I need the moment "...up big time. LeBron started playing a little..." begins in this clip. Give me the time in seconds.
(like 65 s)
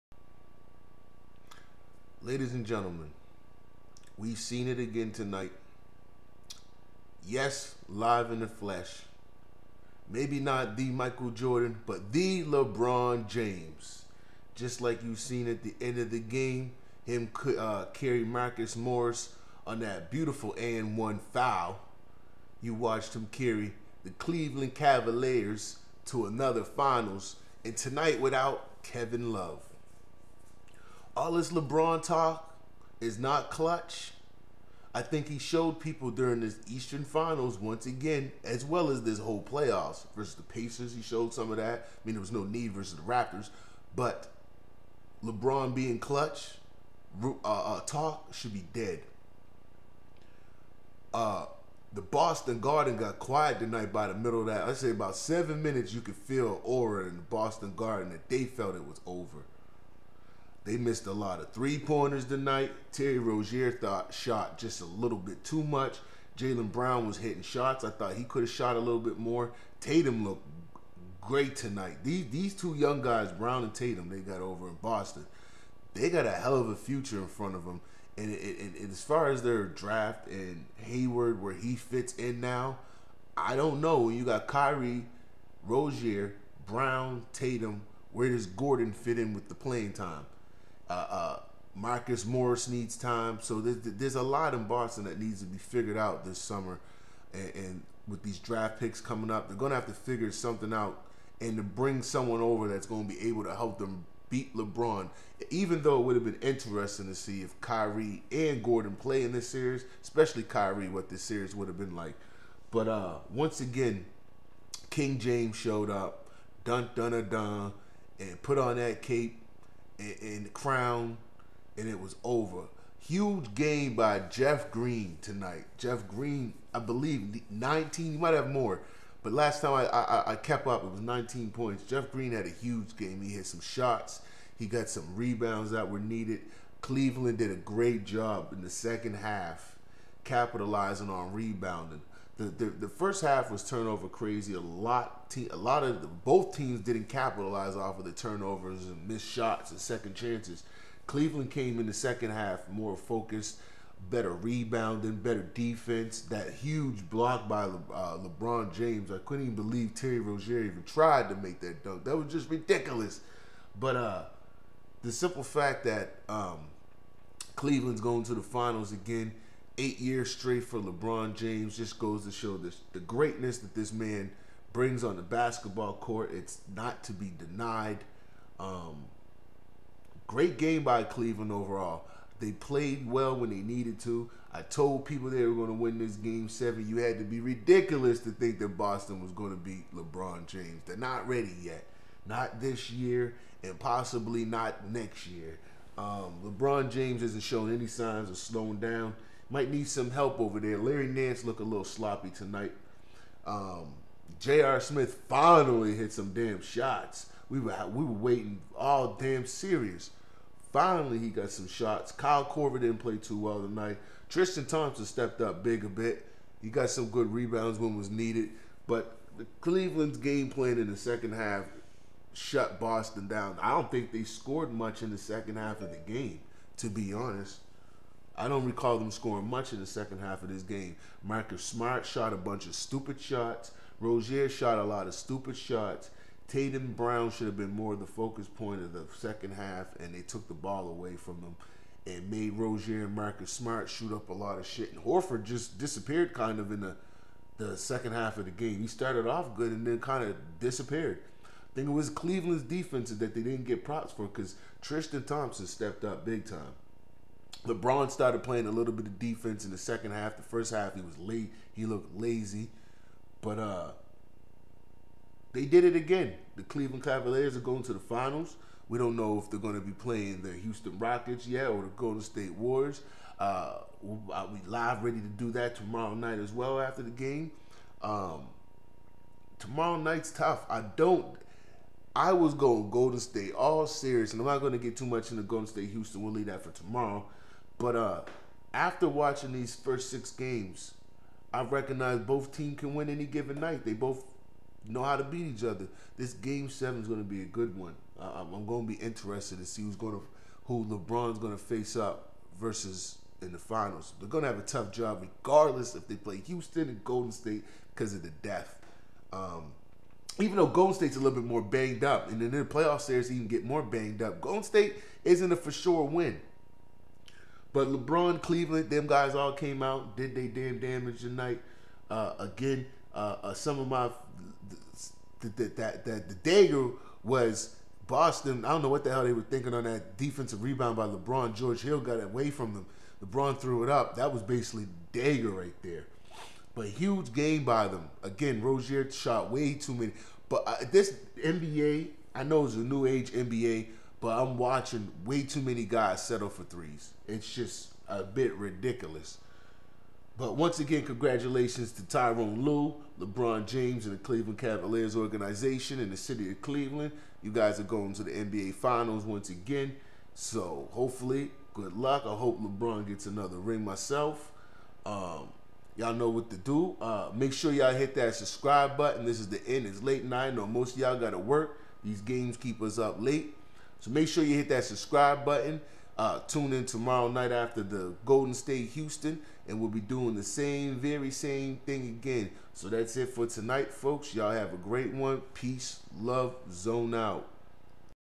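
256 s.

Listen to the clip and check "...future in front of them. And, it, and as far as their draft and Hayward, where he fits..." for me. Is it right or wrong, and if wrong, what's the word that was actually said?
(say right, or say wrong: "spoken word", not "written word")
right.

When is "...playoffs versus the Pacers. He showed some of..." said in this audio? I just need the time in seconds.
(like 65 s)
39 s.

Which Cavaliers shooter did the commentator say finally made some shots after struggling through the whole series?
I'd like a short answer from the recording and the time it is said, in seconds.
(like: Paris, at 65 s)
J.R. Smith, at 204 s.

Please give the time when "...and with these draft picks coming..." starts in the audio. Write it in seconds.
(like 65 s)
97 s.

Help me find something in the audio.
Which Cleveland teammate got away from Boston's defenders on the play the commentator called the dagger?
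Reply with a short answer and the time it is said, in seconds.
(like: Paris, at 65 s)
George Hill, at 331 s.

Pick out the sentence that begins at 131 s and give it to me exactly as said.
Jeff Green had a huge game.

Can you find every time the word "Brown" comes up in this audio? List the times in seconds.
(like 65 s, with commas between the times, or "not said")
66 s, 73 s, 86 s, 236 s.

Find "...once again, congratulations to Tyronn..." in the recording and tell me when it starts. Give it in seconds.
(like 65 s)
350 s.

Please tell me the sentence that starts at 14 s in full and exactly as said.
Just like you've seen at the end of the game, him uh, carry Marcus Morris on that beautiful and one foul.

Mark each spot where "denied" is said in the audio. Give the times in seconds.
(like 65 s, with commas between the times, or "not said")
177 s.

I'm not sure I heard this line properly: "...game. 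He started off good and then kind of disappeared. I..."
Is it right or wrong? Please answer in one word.
right.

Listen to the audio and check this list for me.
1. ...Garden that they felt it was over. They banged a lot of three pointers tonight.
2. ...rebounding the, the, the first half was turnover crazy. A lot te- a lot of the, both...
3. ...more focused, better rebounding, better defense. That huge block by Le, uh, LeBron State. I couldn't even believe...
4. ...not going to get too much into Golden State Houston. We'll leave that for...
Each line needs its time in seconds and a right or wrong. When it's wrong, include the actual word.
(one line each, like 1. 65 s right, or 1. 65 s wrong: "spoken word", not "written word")
1. 57 s wrong: "missed", not "banged"
2. 141 s right
3. 152 s wrong: "James", not "State"
4. 284 s right.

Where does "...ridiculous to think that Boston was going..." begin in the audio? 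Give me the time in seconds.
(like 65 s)
187 s.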